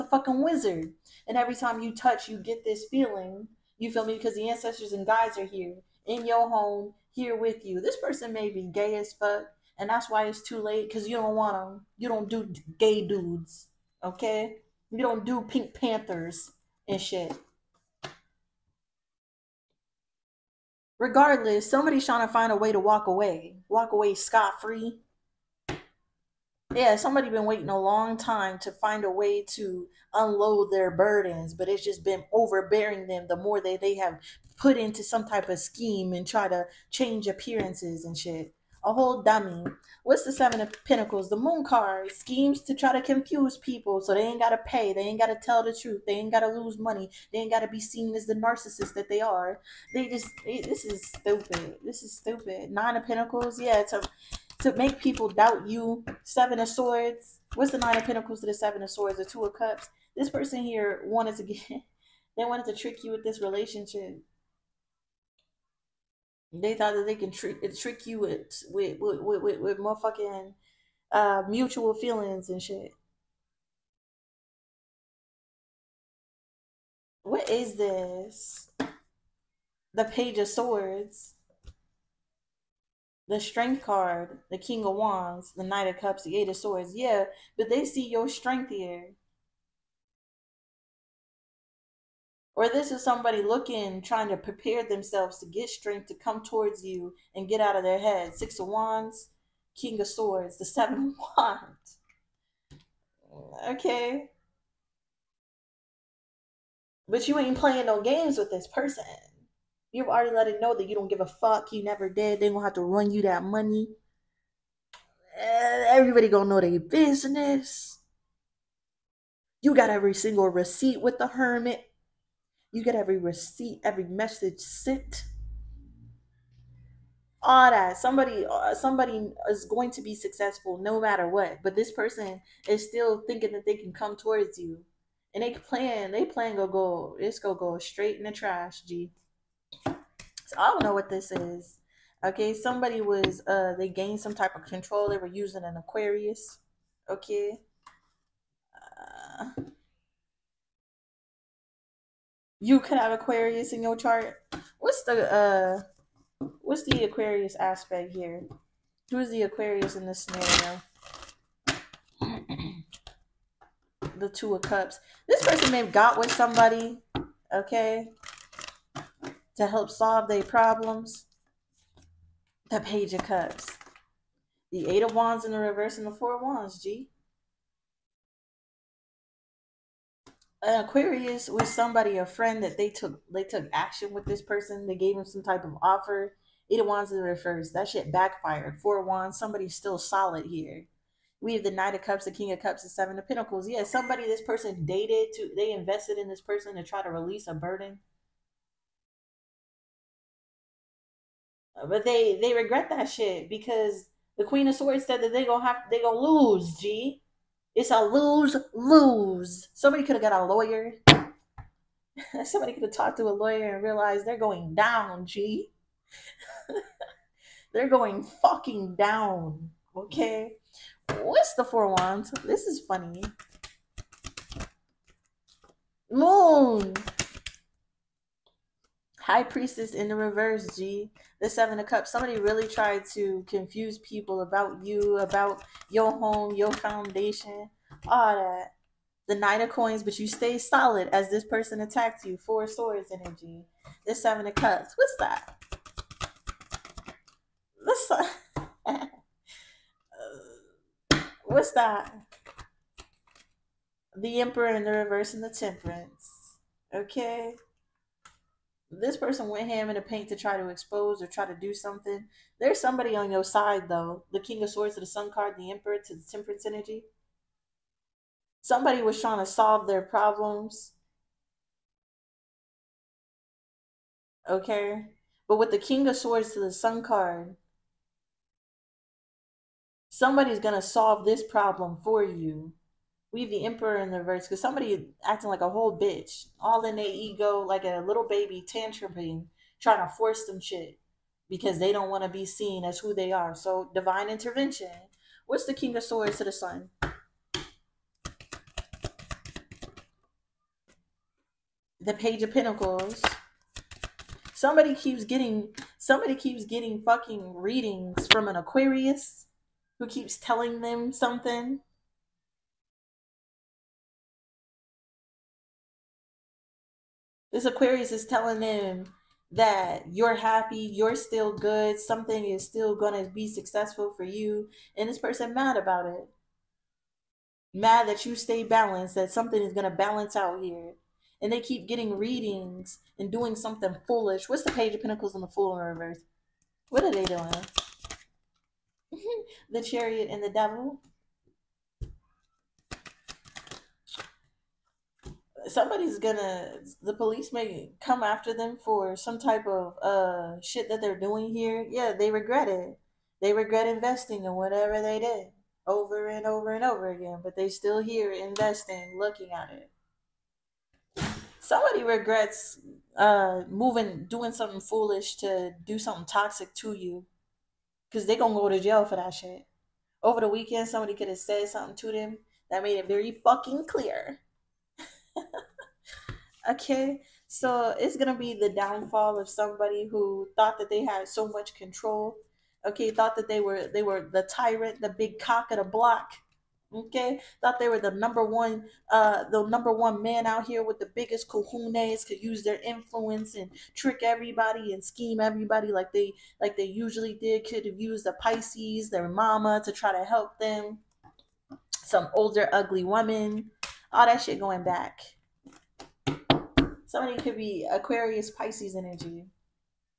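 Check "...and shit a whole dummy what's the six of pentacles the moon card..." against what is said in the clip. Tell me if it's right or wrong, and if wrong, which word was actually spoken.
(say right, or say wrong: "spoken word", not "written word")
wrong: "seven", not "six".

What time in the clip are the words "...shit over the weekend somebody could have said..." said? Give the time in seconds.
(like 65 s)
369 s.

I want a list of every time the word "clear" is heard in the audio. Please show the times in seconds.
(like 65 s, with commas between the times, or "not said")
373 s.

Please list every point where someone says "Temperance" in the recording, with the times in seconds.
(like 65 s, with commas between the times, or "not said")
255 s, 266 s.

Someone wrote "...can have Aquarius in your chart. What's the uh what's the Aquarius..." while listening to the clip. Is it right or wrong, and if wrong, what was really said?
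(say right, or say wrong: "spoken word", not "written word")
right.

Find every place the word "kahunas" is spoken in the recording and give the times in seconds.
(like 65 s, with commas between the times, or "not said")
391 s.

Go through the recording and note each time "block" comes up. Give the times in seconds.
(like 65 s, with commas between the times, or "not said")
385 s.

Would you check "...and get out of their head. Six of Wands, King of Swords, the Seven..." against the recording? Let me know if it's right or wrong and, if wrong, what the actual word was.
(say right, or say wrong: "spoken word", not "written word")
right.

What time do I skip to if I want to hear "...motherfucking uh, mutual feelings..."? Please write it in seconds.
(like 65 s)
69 s.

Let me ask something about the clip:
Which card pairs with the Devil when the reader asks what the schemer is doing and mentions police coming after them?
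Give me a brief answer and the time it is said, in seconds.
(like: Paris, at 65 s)
The Chariot, at 339 s.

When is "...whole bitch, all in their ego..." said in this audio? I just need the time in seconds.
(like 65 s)
285 s.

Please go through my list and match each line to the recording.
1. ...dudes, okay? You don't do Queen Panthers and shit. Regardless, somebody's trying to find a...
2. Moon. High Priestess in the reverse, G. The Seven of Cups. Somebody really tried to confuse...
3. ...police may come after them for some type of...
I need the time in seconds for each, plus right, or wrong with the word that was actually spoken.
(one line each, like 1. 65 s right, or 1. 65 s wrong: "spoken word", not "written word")
1. 13 s wrong: "Pink", not "Queen"
2. 226 s right
3. 347 s right.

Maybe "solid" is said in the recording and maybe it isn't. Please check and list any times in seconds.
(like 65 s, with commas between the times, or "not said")
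189 s, 240 s.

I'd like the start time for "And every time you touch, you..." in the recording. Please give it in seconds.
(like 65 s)
1 s.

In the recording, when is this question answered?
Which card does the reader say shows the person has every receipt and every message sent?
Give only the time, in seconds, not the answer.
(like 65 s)
121 s.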